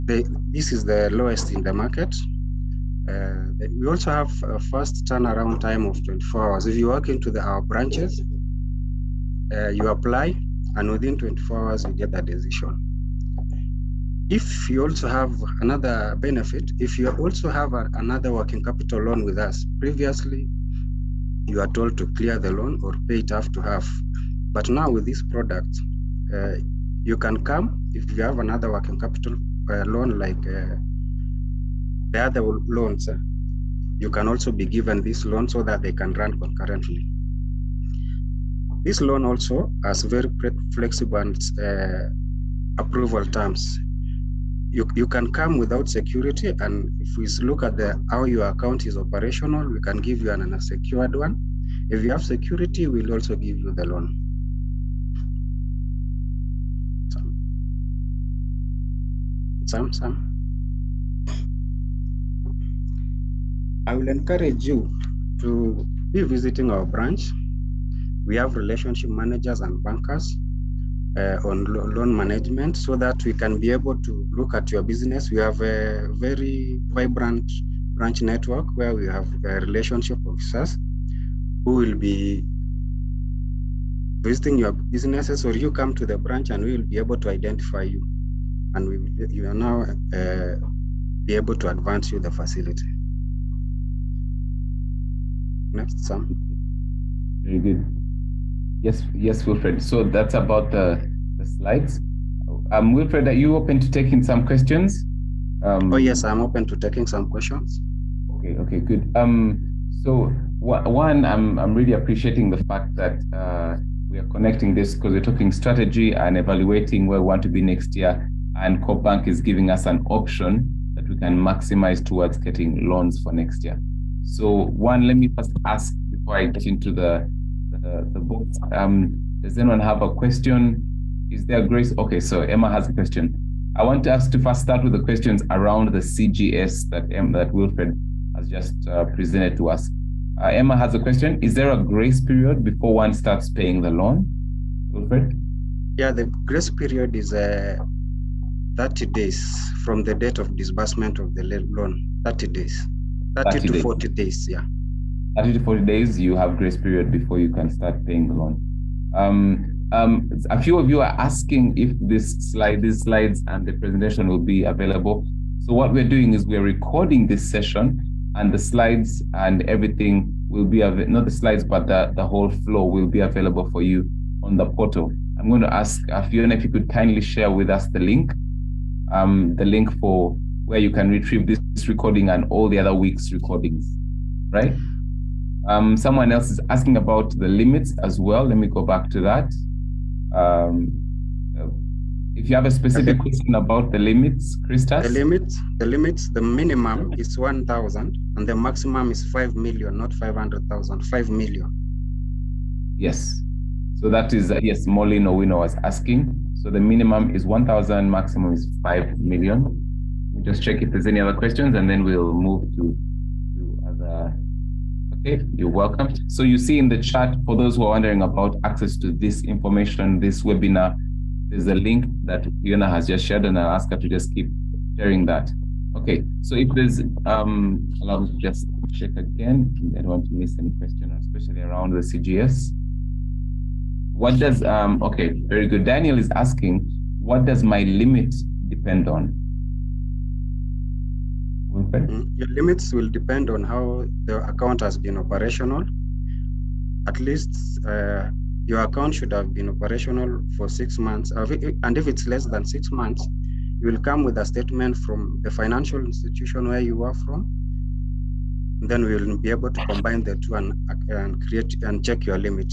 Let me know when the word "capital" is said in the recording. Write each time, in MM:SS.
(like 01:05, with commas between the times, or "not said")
00:18, 00:28.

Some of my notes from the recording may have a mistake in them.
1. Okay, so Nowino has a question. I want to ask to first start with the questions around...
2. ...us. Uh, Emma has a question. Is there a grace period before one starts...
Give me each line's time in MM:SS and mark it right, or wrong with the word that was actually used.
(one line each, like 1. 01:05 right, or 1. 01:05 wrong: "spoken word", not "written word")
1. 02:11 wrong: "Emma", not "Nowino"
2. 02:19 right.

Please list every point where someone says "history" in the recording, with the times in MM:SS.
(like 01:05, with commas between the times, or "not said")
not said.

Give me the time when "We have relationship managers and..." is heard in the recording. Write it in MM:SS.
01:08.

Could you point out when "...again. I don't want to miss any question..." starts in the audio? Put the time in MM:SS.
03:49.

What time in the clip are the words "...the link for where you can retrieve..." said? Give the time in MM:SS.
02:59.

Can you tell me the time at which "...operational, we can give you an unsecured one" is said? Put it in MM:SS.
00:48.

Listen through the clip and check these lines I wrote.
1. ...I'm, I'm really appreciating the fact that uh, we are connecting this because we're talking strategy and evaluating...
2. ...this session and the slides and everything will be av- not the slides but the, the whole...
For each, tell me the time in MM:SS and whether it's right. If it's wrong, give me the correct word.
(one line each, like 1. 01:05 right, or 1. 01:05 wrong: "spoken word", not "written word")
1. 01:51 right
2. 02:47 right.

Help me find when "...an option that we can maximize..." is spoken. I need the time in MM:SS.
01:59.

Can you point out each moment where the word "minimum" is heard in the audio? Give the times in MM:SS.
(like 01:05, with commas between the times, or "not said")
03:16, 03:26.